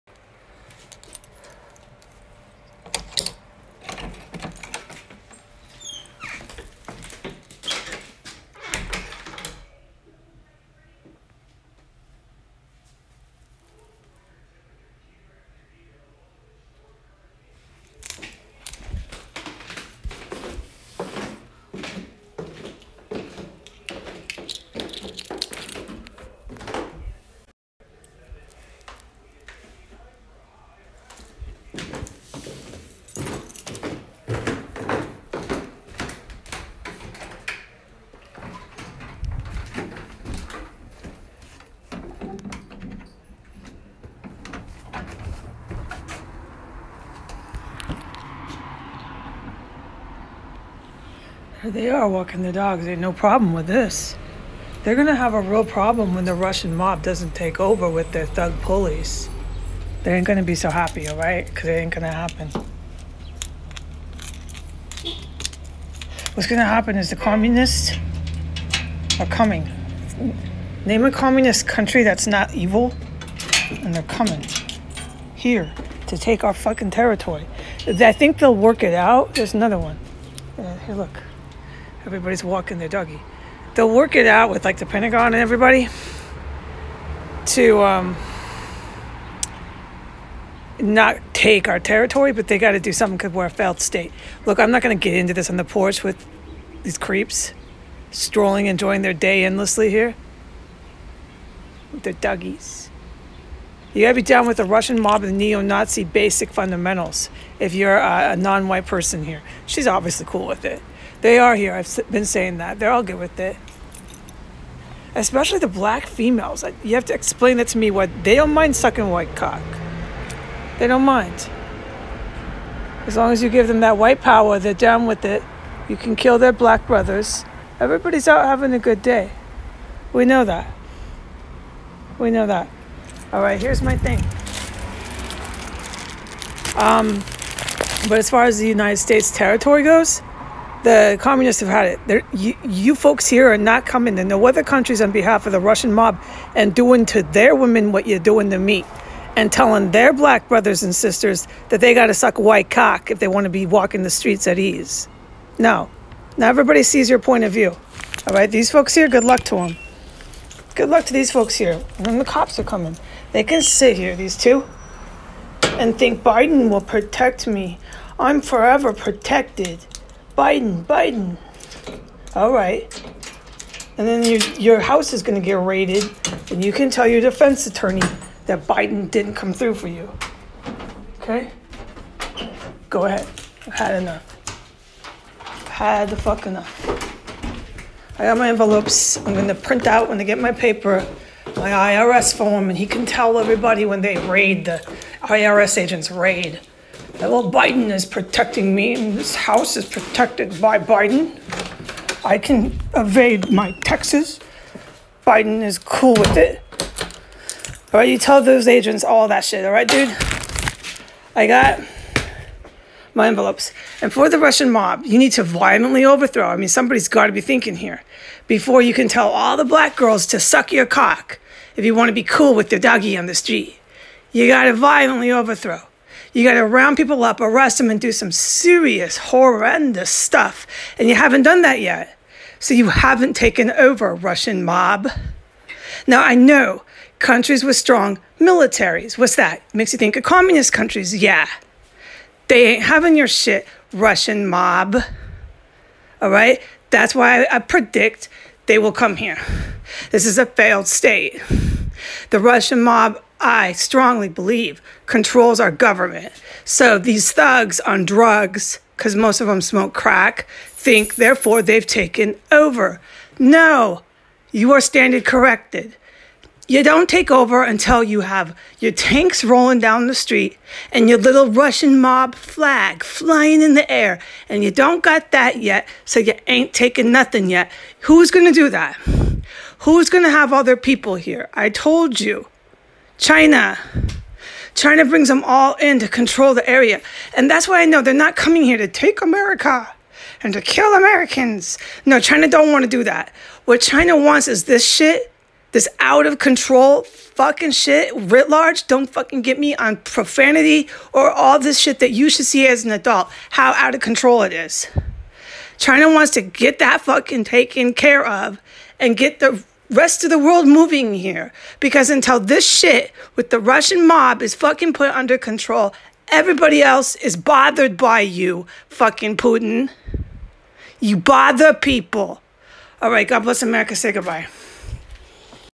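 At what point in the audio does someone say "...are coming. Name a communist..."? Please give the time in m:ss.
1:09.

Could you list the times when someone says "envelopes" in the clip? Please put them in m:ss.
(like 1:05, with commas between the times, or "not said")
3:08, 3:33.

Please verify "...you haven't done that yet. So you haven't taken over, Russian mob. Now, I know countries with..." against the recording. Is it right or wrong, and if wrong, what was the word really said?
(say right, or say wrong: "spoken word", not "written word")
right.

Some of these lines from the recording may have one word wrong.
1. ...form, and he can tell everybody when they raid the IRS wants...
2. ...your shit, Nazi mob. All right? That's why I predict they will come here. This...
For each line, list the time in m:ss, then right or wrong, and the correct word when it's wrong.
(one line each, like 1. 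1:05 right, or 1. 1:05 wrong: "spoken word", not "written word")
1. 3:12 wrong: "agents", not "wants"
2. 4:03 wrong: "Russian", not "Nazi".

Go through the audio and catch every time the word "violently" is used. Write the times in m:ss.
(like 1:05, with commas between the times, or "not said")
3:35, 3:44.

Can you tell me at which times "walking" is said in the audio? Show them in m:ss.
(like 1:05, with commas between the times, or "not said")
0:52, 1:22, 2:33.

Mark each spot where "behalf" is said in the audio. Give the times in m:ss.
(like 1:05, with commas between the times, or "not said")
2:25.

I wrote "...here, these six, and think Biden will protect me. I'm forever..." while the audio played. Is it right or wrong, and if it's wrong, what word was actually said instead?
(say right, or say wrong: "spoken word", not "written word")
wrong: "two", not "six".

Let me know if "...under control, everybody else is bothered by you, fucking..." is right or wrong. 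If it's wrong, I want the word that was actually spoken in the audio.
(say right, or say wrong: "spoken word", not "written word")
right.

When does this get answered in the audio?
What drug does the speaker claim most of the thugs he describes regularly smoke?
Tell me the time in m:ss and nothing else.
4:19.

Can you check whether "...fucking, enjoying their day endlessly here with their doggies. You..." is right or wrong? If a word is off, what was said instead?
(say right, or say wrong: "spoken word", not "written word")
wrong: "strolling", not "fucking".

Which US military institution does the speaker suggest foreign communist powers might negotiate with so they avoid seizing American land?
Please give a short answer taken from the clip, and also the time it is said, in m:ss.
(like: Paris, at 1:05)
Pentagon, at 1:24.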